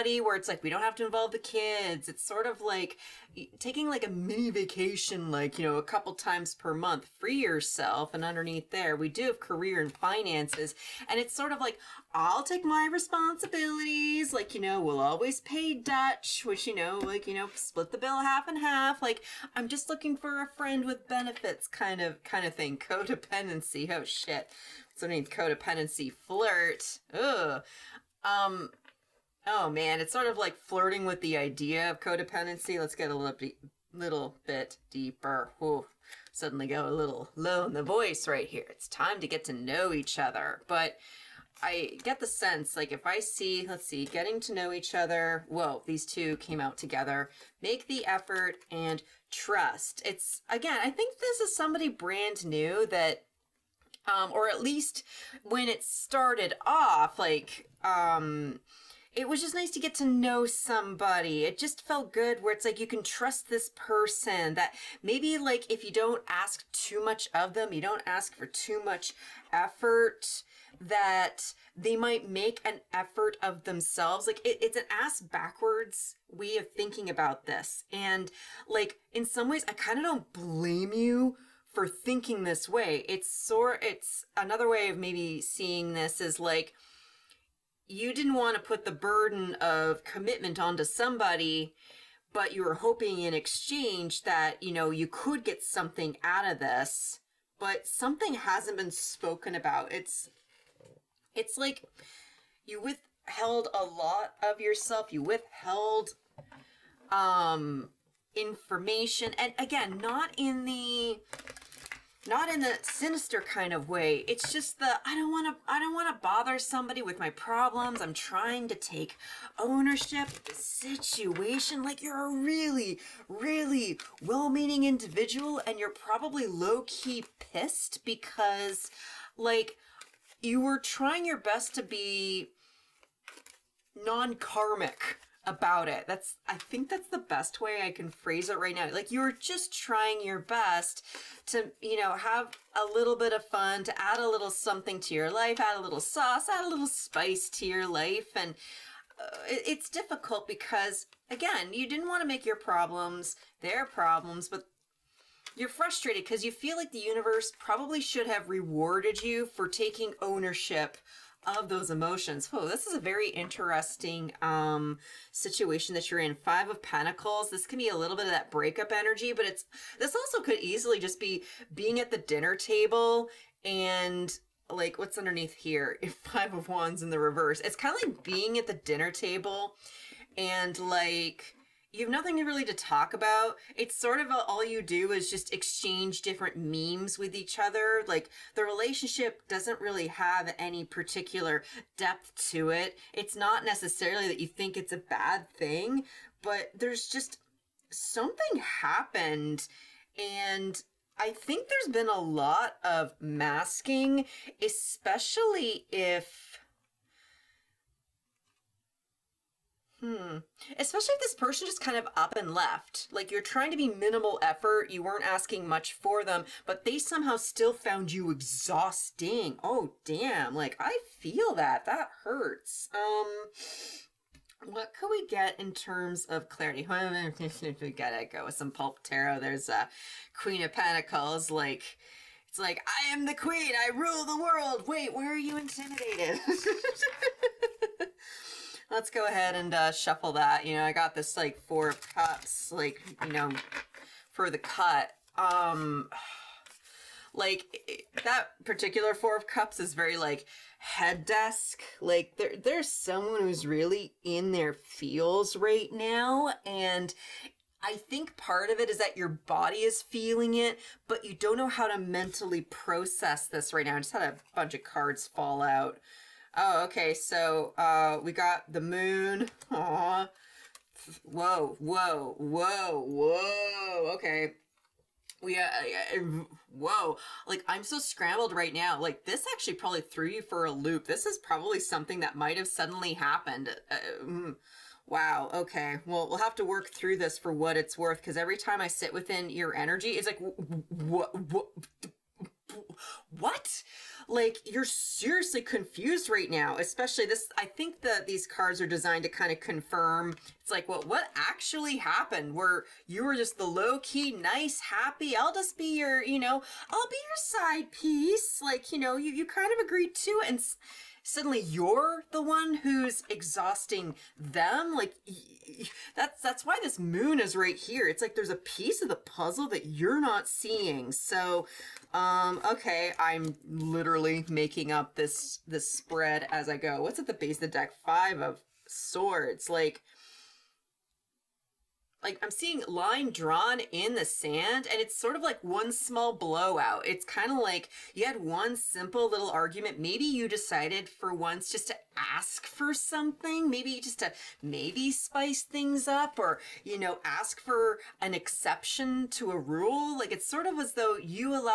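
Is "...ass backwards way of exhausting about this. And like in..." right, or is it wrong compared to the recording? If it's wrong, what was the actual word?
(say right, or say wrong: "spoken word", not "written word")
wrong: "thinking", not "exhausting".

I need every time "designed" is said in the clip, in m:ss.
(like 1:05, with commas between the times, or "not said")
4:58.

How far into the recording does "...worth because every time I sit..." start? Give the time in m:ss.
4:47.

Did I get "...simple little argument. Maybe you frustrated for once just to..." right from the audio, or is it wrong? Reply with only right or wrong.
wrong.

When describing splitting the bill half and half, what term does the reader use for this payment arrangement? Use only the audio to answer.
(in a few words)
pay dutch.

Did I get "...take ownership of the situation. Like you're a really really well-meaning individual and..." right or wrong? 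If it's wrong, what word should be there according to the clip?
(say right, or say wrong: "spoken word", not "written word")
right.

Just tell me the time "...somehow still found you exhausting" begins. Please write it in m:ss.
3:36.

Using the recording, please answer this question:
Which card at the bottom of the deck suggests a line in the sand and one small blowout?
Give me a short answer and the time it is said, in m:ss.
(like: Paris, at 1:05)
Five of Swords, at 5:28.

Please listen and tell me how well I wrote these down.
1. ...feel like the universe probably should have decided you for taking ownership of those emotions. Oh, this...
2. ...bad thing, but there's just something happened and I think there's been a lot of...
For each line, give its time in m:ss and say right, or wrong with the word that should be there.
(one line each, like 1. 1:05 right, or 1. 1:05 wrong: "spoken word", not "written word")
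1. 2:36 wrong: "rewarded", not "decided"
2. 3:14 right.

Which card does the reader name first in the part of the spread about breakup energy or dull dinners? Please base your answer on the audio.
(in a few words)
Five of Pentacles.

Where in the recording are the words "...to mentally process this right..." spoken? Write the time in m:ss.
4:21.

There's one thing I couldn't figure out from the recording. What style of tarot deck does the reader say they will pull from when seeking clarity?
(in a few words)
pulp tarot.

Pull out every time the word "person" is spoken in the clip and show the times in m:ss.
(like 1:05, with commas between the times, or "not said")
1:03, 3:31.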